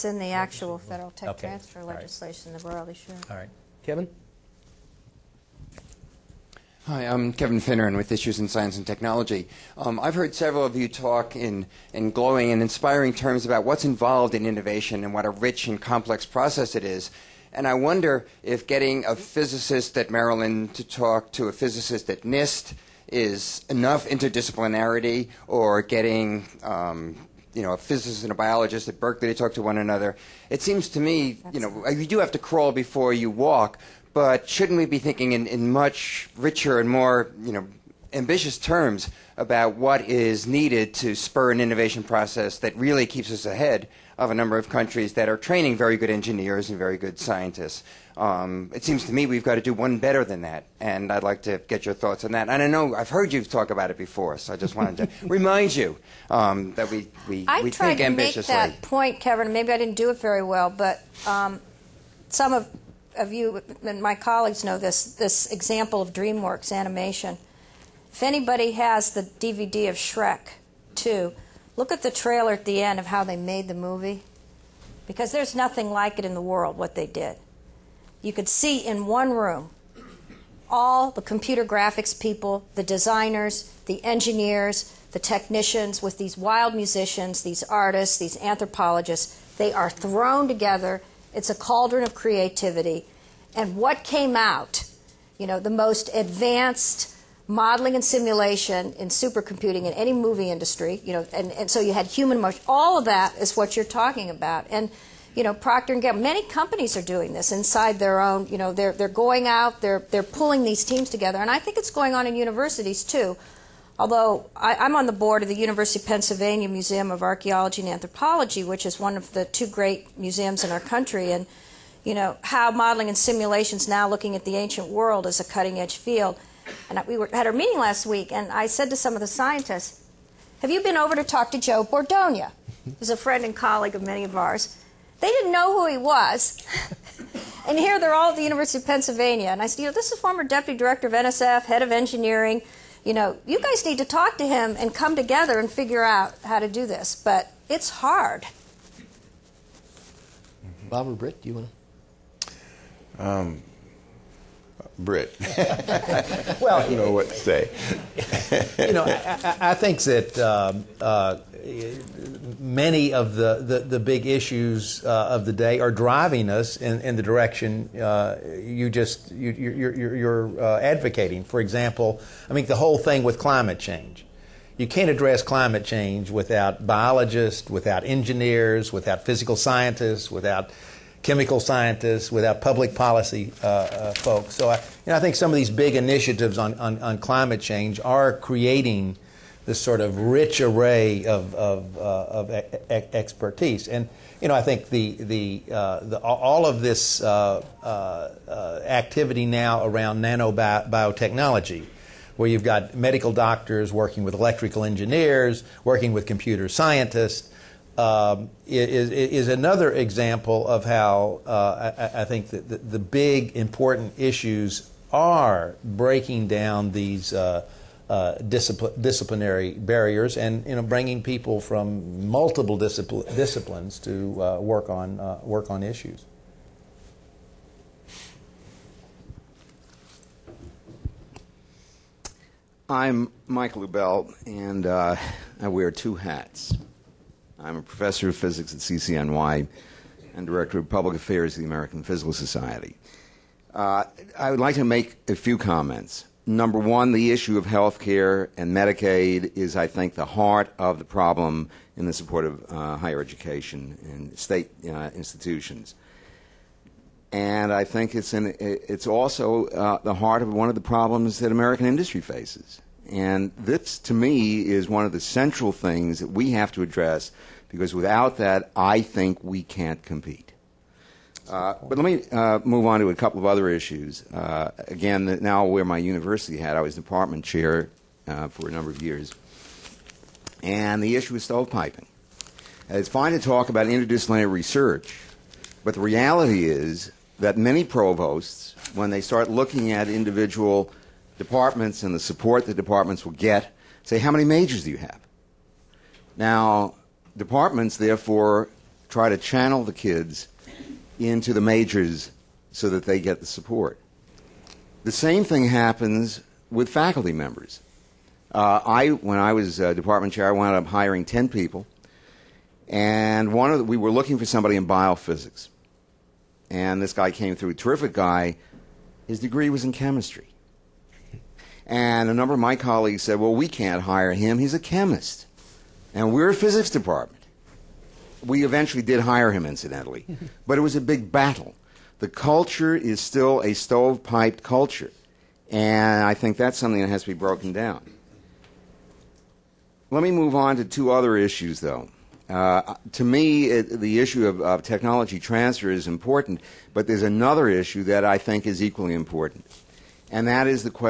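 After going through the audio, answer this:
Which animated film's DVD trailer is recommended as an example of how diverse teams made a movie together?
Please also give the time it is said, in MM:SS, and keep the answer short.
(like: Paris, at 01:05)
Shrek 2, at 01:09.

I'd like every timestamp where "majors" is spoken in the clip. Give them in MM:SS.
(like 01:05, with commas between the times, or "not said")
04:54, 05:01.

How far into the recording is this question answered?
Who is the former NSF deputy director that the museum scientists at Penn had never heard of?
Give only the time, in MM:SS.
02:11.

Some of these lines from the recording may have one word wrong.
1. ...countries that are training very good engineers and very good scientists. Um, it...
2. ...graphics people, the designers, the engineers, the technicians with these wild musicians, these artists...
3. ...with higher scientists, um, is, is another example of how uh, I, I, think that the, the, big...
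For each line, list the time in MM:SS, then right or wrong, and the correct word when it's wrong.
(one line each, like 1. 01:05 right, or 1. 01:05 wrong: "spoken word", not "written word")
1. 00:44 right
2. 01:21 right
3. 03:26 wrong: "computer", not "higher".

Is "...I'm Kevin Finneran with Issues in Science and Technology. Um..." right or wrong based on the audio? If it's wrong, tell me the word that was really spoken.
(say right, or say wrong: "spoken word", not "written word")
right.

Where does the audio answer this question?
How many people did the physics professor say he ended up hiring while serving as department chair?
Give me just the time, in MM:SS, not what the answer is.
05:11.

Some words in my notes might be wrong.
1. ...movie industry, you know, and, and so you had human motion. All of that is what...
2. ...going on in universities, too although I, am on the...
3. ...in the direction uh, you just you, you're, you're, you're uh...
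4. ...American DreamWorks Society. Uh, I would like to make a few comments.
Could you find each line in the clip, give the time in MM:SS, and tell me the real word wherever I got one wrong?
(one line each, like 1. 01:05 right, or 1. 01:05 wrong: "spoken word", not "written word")
1. 01:40 right
2. 01:51 right
3. 02:47 right
4. 04:01 wrong: "Physical", not "DreamWorks".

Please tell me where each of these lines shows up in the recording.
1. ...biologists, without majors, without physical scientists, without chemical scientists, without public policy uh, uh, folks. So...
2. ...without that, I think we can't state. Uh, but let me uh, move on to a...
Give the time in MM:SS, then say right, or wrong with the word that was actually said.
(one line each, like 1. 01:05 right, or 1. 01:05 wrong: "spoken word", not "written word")
1. 02:56 wrong: "engineers", not "majors"
2. 04:27 wrong: "compete", not "state".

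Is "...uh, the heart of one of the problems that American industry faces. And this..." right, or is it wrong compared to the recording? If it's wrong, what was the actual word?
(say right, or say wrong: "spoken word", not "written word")
right.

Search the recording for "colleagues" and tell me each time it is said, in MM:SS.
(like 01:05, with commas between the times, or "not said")
01:04, 02:13, 05:22.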